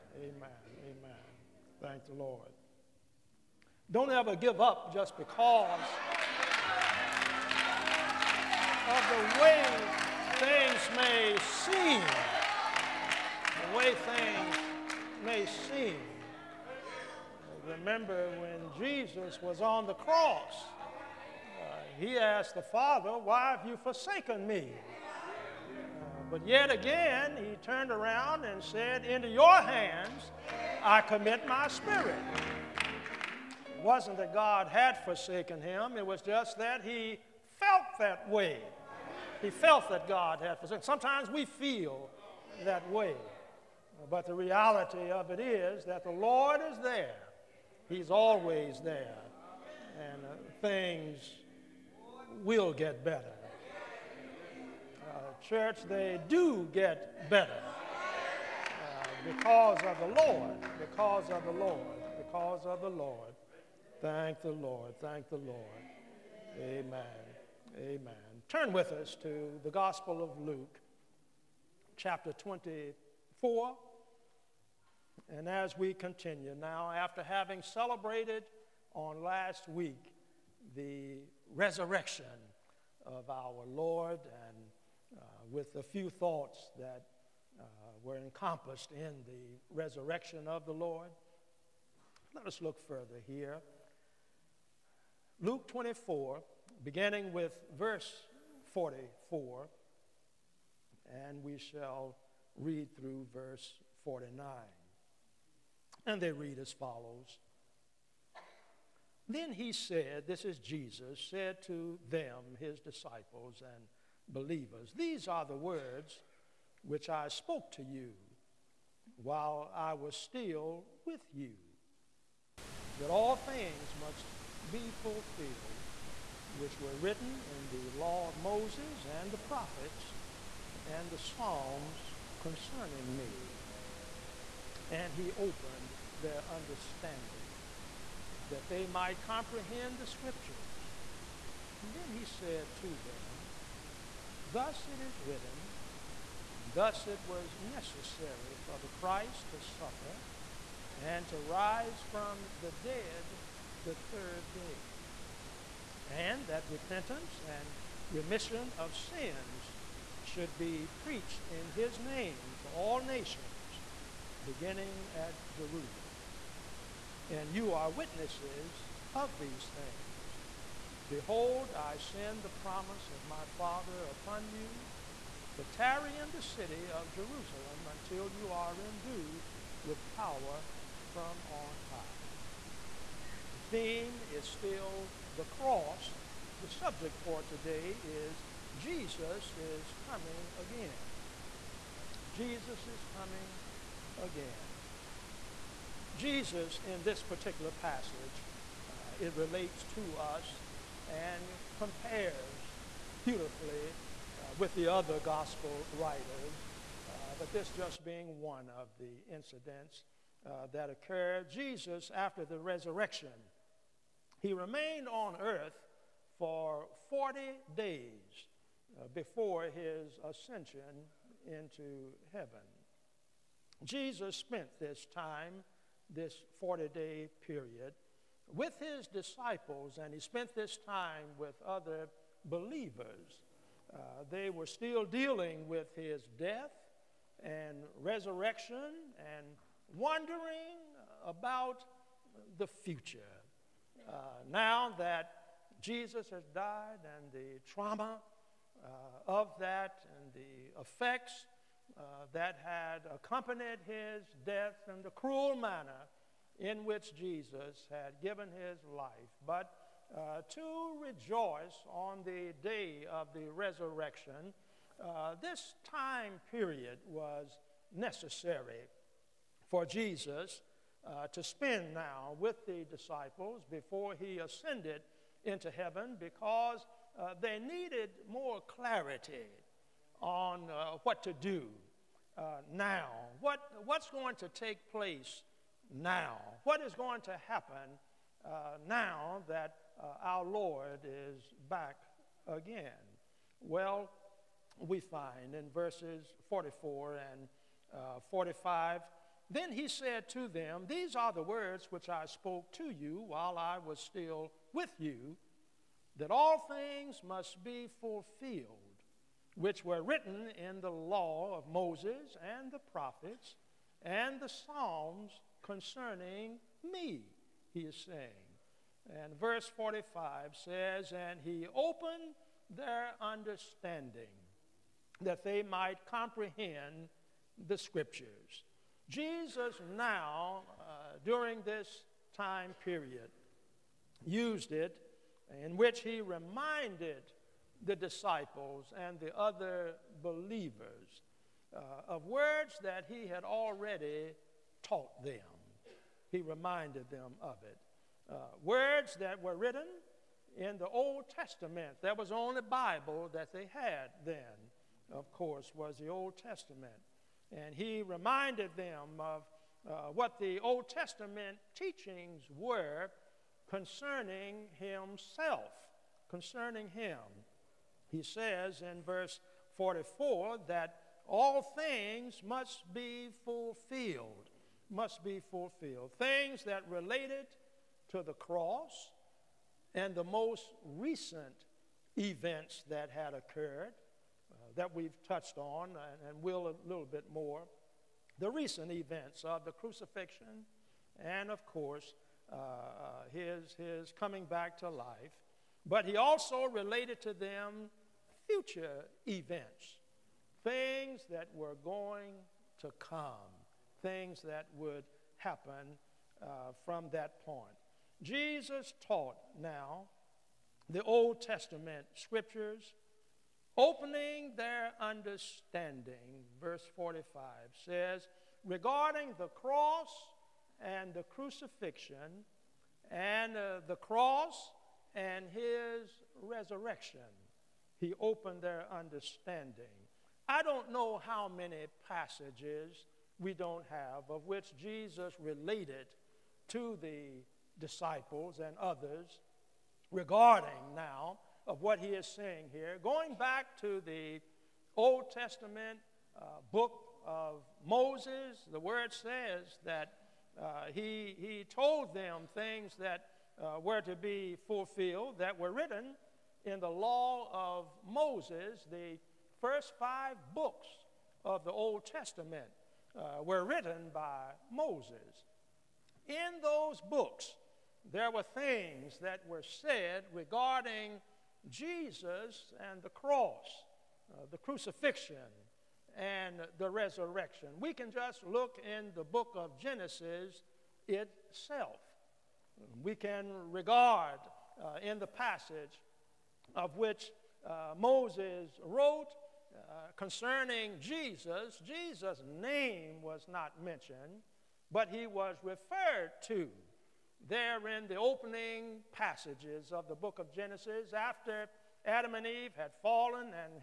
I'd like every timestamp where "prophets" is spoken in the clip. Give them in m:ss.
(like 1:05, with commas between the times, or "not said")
2:09, 5:12.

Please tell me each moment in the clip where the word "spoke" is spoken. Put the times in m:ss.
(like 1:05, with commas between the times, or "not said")
1:57, 5:02.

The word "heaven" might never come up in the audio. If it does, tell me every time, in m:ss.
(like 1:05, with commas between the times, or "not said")
3:42, 4:35.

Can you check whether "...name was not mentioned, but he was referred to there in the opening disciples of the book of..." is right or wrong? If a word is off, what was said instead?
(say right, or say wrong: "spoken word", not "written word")
wrong: "passages", not "disciples".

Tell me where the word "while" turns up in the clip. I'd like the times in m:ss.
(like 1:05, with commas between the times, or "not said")
1:59, 5:03.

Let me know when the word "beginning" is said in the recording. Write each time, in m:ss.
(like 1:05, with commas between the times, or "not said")
1:36, 2:44.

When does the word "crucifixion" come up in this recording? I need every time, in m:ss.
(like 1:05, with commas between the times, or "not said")
6:29, 7:01, 7:54.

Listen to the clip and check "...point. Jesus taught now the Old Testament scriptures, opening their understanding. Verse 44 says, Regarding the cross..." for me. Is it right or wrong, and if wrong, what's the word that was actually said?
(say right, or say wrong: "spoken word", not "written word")
wrong: "45", not "44".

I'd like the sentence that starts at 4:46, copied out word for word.
What is going to happen uh, now that uh, our Lord is back again?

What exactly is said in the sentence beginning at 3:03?
The theme is still the cross.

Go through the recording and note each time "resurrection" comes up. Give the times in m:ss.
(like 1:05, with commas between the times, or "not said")
1:21, 1:29, 3:32, 3:58, 4:23, 7:06, 7:56.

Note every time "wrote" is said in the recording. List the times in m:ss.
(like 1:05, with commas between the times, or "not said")
8:08.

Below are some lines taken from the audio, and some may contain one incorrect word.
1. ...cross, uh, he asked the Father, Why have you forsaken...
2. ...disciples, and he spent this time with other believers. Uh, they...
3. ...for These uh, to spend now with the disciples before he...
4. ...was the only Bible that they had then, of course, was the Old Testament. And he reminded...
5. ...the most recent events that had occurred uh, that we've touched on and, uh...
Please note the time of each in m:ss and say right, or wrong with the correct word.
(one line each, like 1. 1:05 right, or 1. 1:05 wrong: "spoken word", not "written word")
1. 0:19 right
2. 3:49 right
3. 4:29 wrong: "Jesus", not "These"
4. 5:52 right
5. 6:20 right.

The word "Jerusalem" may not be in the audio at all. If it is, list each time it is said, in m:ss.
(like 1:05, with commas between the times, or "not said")
2:45, 2:57.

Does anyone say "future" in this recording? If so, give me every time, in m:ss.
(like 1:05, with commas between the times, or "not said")
4:02, 6:38.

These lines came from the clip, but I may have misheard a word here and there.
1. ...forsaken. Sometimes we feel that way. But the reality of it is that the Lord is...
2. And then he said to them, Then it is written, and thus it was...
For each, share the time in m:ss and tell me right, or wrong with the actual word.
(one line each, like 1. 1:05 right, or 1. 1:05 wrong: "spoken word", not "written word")
1. 0:40 right
2. 2:21 wrong: "Thus", not "Then".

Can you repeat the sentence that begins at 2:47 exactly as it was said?
And you are witnesses of these things.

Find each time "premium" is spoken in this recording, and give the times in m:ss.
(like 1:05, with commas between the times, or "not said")
not said.